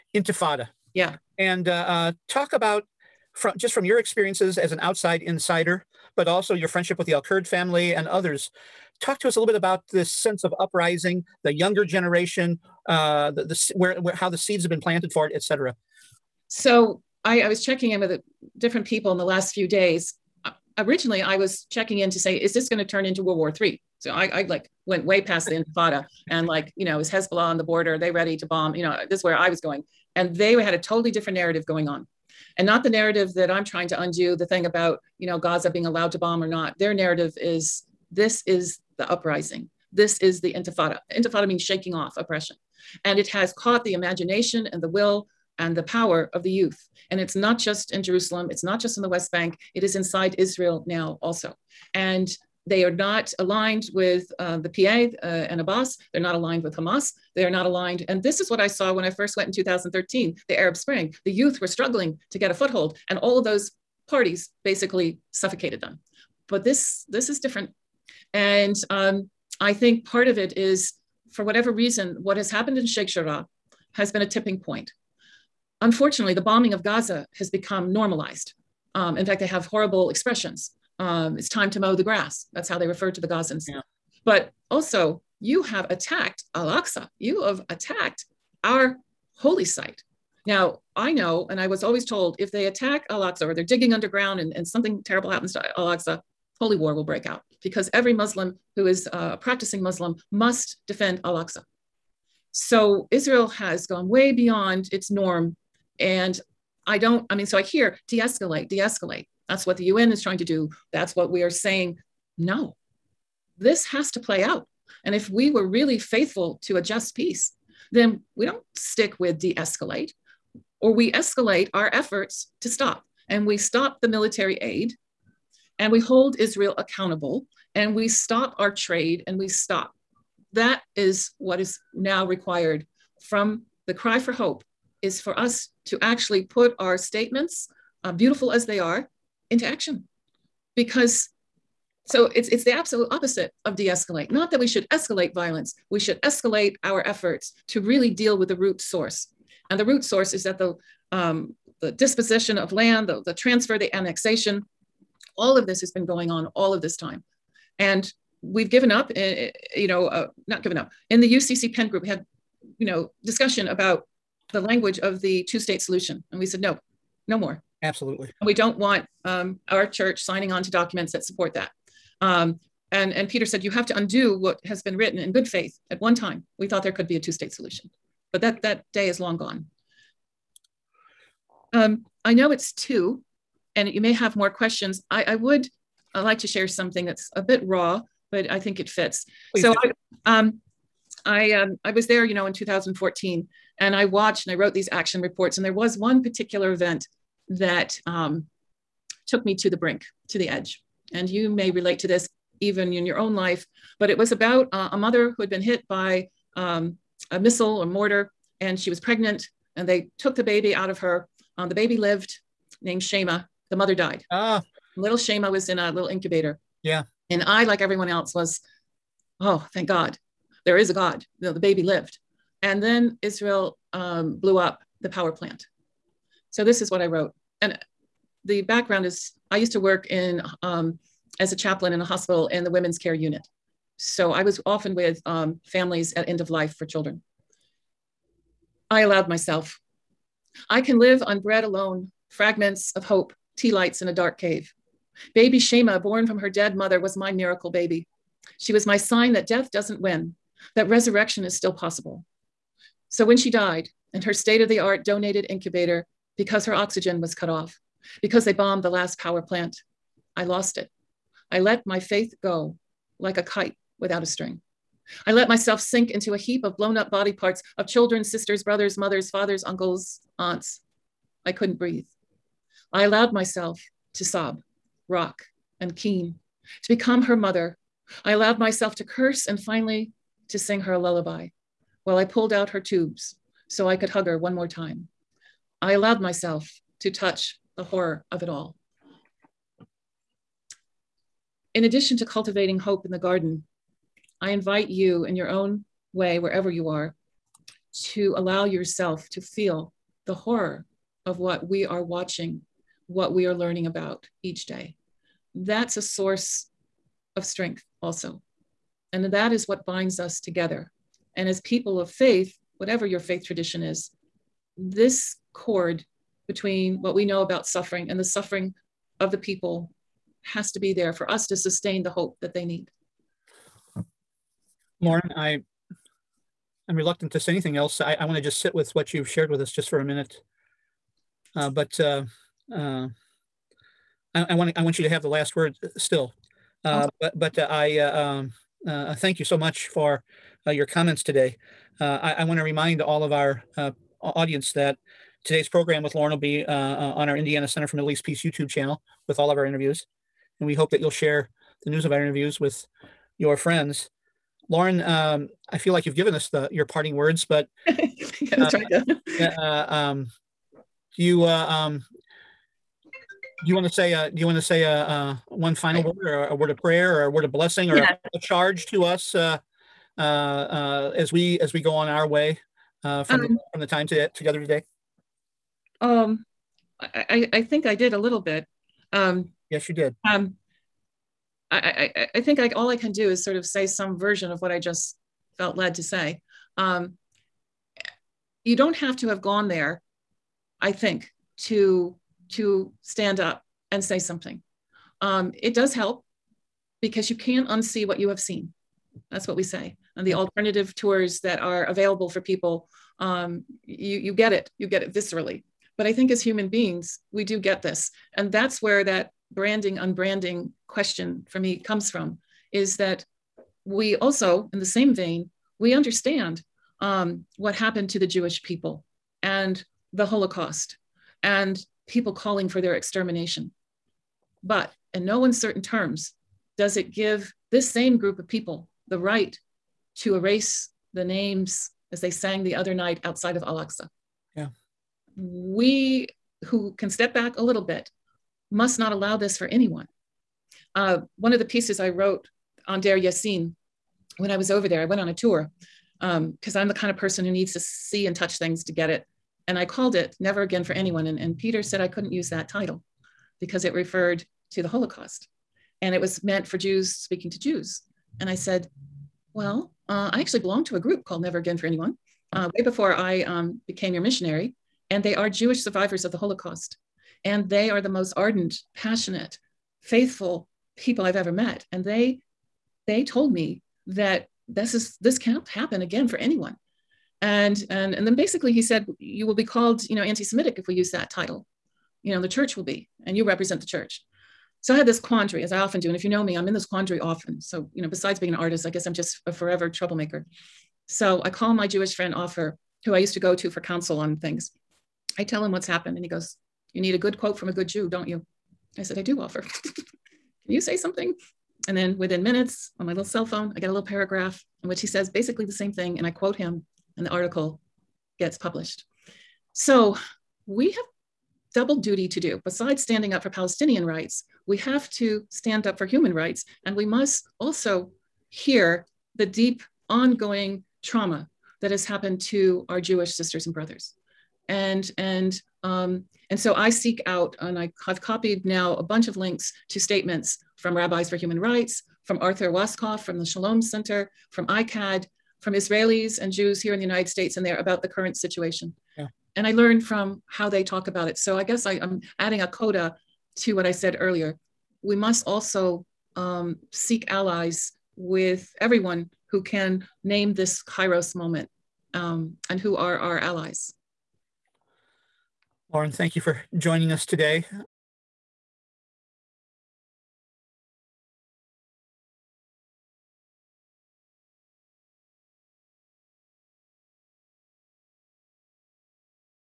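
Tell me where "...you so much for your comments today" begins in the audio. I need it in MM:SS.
05:39.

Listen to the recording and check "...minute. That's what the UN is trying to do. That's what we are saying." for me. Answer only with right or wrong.
wrong.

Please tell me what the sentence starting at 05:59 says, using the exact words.
Uh, uh, um, you uh, um, do you want to say uh, do you want to say uh, uh, one final right.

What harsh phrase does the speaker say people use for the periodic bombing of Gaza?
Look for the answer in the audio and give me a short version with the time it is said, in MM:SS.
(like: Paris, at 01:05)
mow the grass, at 01:21.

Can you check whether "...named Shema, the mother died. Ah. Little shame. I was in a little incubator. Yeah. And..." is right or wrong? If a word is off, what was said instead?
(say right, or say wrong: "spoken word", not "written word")
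right.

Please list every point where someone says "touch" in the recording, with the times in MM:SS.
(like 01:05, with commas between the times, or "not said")
04:47, 07:28.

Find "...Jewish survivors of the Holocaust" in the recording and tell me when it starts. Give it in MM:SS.
07:45.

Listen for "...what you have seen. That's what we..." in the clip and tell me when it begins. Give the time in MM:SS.
06:38.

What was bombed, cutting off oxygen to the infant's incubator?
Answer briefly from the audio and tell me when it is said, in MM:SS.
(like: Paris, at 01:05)
the last power plant, at 04:18.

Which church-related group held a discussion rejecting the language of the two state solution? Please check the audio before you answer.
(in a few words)
UCC PIN group.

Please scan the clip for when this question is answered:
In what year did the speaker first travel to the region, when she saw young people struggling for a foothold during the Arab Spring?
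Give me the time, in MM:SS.
00:59.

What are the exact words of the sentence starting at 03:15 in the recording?
And there was one particular event that um, took me to the brink, to the edge.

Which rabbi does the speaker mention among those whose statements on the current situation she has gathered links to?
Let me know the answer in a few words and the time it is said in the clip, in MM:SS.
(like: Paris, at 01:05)
Arthur Waskow, at 08:52.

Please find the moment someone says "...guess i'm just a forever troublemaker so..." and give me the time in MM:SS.
08:08.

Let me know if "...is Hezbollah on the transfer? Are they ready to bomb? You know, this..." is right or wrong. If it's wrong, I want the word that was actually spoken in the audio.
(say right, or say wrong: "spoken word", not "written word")
wrong: "border", not "transfer".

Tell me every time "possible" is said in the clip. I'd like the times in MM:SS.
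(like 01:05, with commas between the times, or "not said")
04:11.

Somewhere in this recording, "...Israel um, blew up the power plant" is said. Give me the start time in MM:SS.
03:43.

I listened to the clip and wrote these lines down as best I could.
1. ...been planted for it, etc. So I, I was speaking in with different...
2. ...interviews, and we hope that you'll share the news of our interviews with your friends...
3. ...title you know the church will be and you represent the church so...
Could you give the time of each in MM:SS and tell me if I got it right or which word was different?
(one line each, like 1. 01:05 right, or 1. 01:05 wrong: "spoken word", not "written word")
1. 00:14 wrong: "checking", not "speaking"
2. 05:49 right
3. 08:01 right.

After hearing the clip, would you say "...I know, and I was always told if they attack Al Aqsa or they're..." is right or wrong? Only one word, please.
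right.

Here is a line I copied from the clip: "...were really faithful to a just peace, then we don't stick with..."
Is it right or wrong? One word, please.
right.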